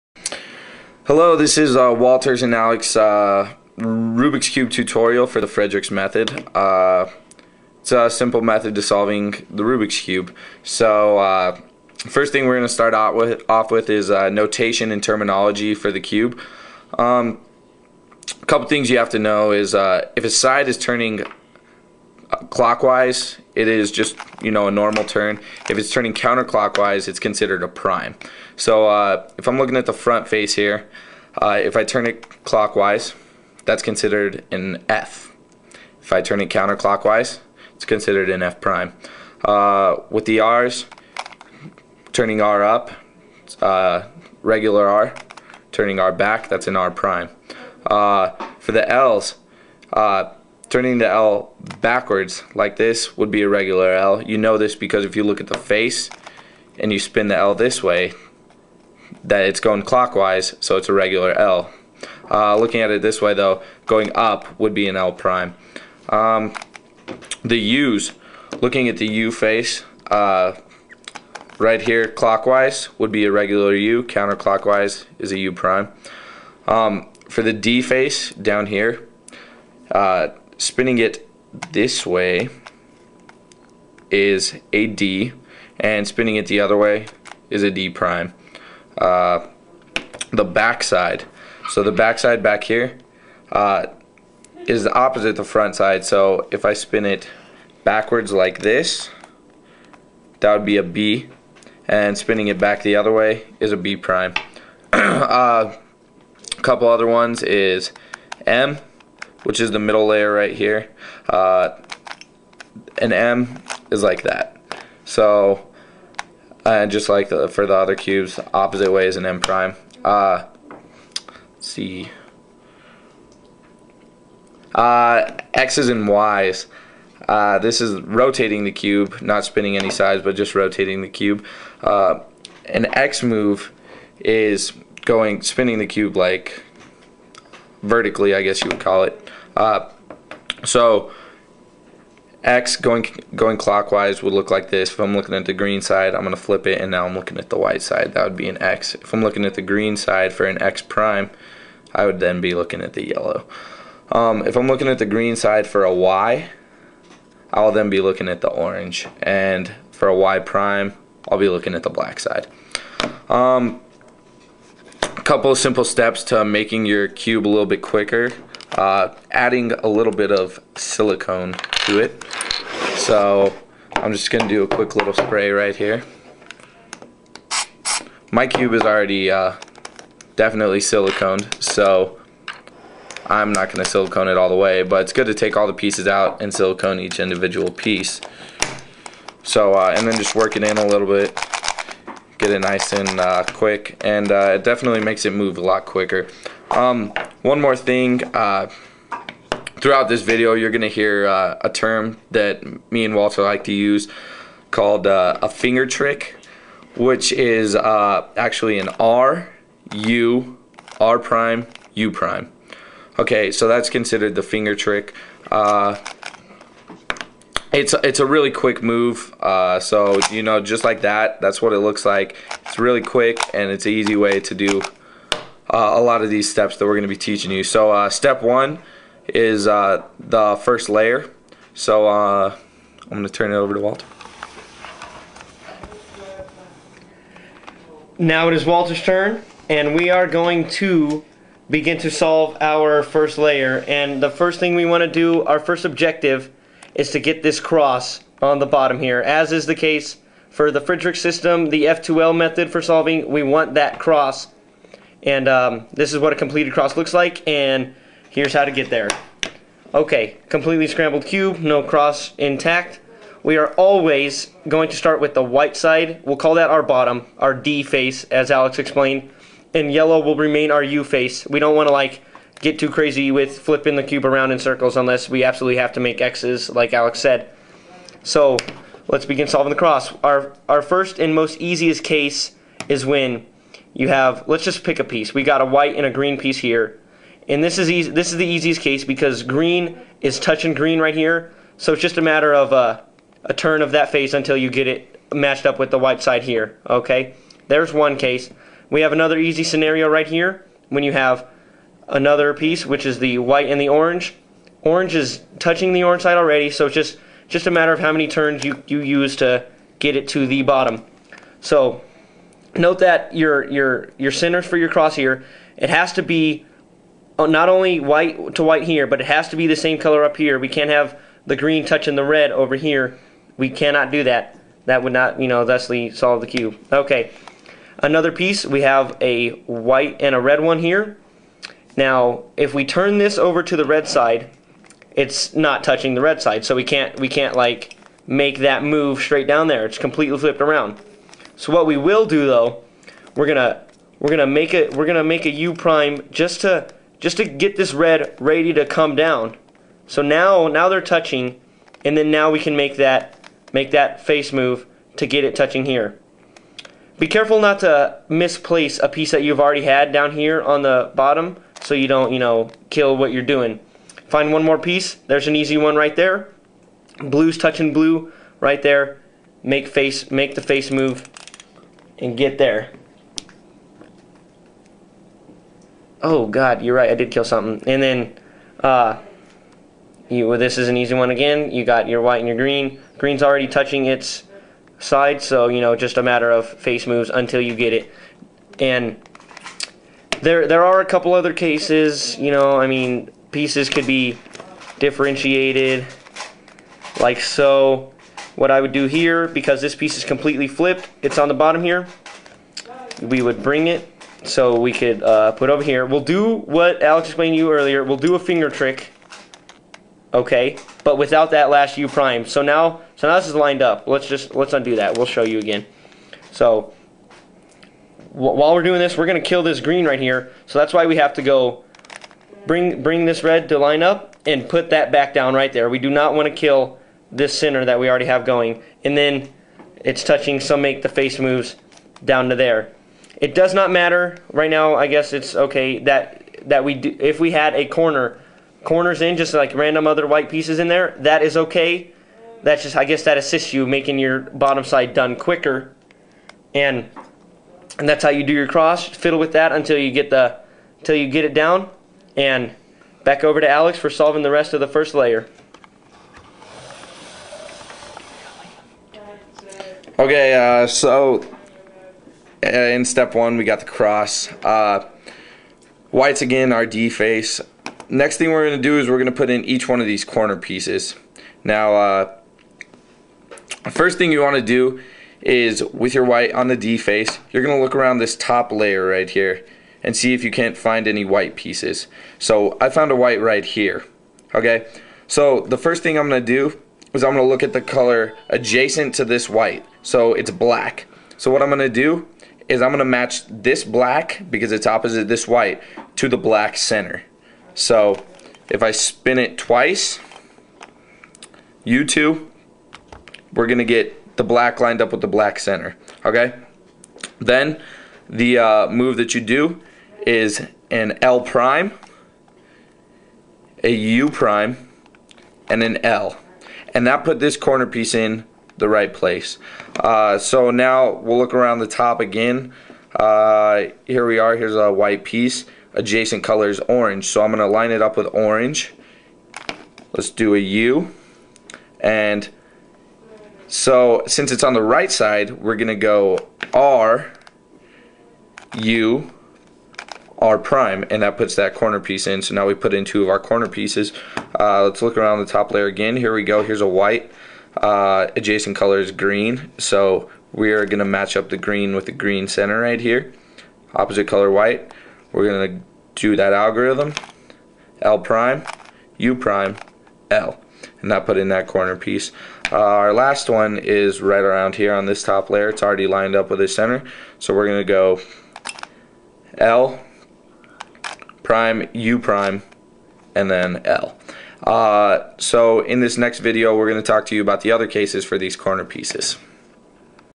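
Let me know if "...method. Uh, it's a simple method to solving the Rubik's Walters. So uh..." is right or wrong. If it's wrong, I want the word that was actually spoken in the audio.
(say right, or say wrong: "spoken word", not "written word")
wrong: "Cube", not "Walters".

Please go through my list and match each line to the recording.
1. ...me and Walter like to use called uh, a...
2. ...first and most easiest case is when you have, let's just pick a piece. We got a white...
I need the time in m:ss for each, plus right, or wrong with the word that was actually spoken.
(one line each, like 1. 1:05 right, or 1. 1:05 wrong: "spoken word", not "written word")
1. 3:22 right
2. 4:40 right.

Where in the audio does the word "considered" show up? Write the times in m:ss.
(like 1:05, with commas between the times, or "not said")
0:27, 0:33, 0:37, 3:33.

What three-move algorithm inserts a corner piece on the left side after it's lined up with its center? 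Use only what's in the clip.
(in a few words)
L prime, U prime, L.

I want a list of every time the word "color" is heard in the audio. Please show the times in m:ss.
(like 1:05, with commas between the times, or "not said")
5:19, 8:07, 8:46, 9:08, 9:14.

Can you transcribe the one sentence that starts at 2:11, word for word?
Uh, an X move is going spinning the cube like vertically, I guess you would call it.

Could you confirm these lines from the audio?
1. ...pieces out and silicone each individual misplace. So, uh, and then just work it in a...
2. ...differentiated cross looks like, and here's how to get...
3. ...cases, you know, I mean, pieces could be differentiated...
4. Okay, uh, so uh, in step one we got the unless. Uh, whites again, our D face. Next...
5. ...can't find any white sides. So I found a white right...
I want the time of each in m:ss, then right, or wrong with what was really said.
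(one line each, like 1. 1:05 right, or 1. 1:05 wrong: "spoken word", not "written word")
1. 3:05 wrong: "piece", not "misplace"
2. 4:16 wrong: "completed", not "differentiated"
3. 6:31 right
4. 7:40 wrong: "cross", not "unless"
5. 8:00 wrong: "pieces", not "sides".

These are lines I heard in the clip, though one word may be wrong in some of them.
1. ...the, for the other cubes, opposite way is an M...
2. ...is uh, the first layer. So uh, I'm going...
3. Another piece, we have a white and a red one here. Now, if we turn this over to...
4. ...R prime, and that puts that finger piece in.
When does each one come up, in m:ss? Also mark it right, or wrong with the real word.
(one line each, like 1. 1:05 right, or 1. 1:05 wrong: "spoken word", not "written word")
1. 1:57 right
2. 3:49 right
3. 5:27 right
4. 9:00 wrong: "corner", not "finger".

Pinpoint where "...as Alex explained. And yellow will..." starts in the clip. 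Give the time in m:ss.
4:28.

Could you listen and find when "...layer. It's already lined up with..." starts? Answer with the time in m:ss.
9:25.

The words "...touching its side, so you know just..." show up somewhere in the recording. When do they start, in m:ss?
6:23.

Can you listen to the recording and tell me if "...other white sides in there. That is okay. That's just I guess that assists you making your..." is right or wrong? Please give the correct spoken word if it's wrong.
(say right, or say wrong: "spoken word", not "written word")
wrong: "pieces", not "sides".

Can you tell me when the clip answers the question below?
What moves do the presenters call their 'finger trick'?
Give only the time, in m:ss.
3:28.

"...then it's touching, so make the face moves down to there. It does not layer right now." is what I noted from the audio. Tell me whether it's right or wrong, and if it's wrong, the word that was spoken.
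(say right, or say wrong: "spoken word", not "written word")
wrong: "matter", not "layer".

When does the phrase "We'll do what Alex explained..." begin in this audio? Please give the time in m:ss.
6:46.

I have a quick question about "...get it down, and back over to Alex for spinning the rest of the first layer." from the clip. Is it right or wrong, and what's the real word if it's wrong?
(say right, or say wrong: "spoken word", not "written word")
wrong: "solving", not "spinning".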